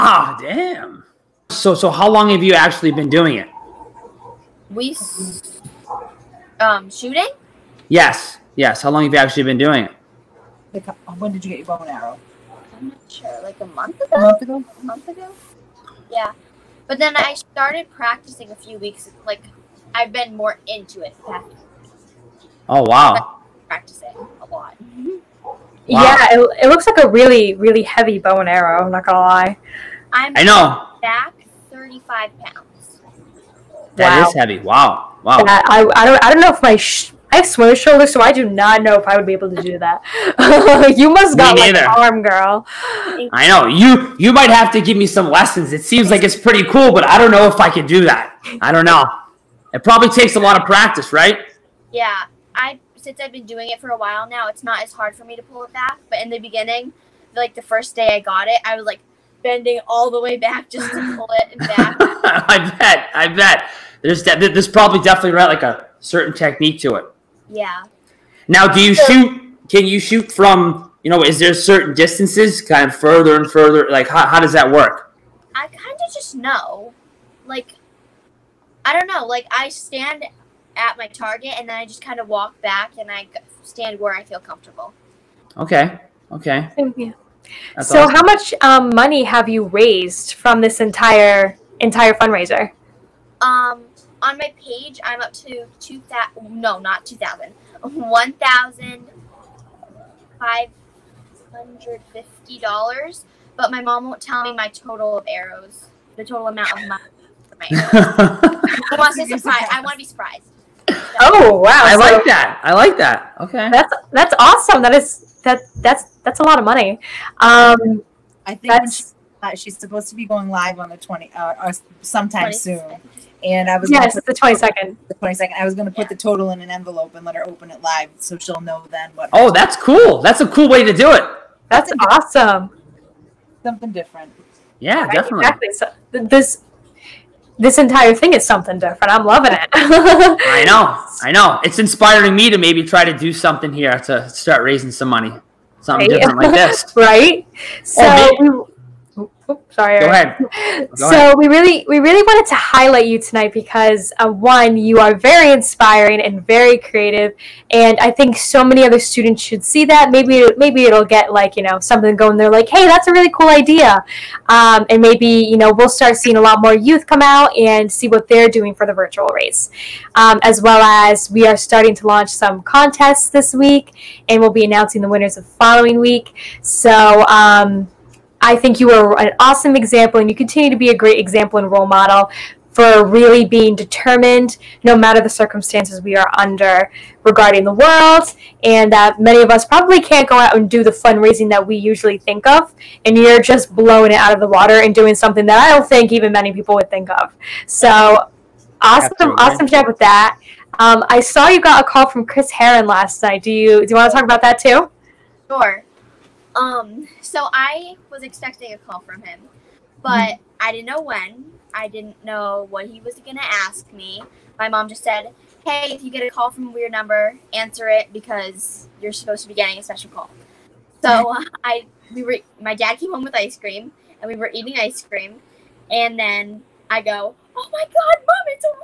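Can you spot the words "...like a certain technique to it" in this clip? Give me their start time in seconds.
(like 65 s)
65 s.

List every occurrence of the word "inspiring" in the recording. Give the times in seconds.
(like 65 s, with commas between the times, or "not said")
141 s, 155 s.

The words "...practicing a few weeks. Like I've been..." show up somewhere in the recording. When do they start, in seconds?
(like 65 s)
17 s.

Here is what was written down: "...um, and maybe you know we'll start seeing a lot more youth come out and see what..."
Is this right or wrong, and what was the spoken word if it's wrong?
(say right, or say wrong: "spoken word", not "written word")
right.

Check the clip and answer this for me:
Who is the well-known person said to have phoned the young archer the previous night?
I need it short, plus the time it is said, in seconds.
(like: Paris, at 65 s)
Chris Herren, at 202 s.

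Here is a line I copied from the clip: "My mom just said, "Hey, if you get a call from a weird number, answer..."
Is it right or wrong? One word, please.
right.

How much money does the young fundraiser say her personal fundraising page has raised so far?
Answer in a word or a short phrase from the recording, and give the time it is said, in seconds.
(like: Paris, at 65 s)
1,550, at 97 s.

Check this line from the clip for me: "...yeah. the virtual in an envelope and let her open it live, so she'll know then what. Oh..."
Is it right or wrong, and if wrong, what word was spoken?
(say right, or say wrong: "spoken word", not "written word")
wrong: "total", not "virtual".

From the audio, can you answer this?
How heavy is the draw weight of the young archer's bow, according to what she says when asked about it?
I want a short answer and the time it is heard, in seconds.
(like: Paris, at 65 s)
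35 pounds, at 31 s.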